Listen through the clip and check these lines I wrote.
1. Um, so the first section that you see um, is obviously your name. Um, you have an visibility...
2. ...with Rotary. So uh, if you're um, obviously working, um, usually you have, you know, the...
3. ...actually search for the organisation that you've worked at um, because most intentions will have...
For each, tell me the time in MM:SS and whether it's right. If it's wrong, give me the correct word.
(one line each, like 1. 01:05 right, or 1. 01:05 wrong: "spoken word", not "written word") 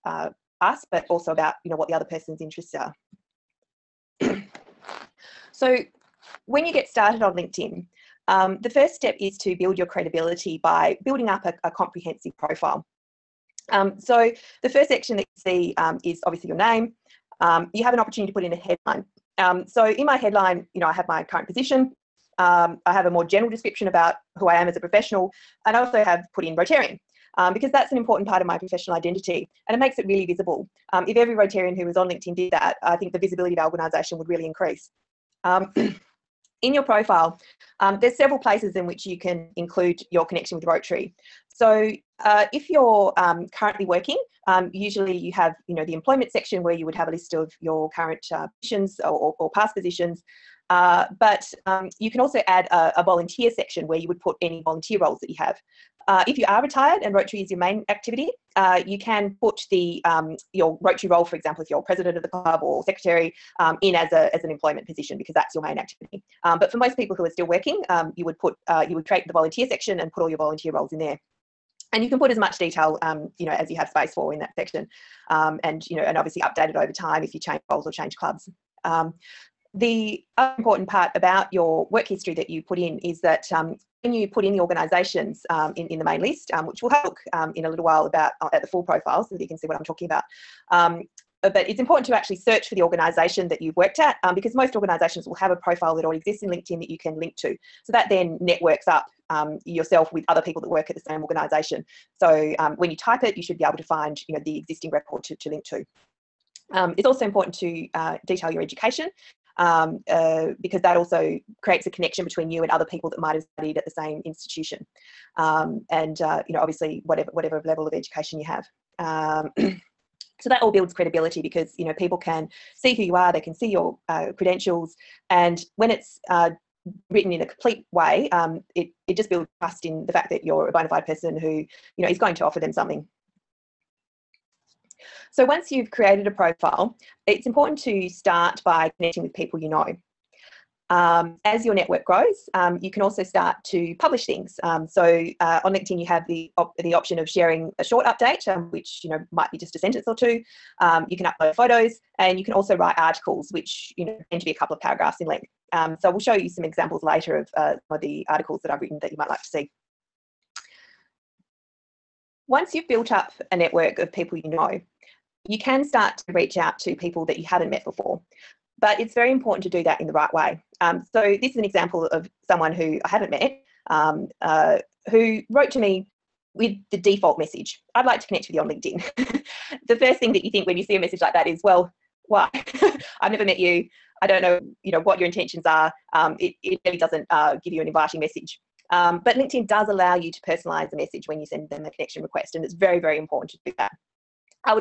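1. 00:13 wrong: "opportunity", not "visibility"
2. 00:40 wrong: "currently", not "obviously"
3. 01:32 wrong: "organisations", not "intentions".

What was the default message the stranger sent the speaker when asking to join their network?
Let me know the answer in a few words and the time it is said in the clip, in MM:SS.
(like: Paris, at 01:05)
I'd like to connect with you on LinkedIn, at 02:57.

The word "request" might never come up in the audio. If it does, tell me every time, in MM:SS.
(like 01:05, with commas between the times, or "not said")
03:12.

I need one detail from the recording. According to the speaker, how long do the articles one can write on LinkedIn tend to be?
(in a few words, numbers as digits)
a couple of paragraphs.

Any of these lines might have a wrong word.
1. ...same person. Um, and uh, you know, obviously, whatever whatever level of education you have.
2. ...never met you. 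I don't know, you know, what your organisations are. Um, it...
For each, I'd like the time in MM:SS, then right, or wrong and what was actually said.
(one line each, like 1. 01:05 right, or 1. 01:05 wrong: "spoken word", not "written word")
1. 01:53 wrong: "institution", not "person"
2. 03:03 wrong: "intentions", not "organisations".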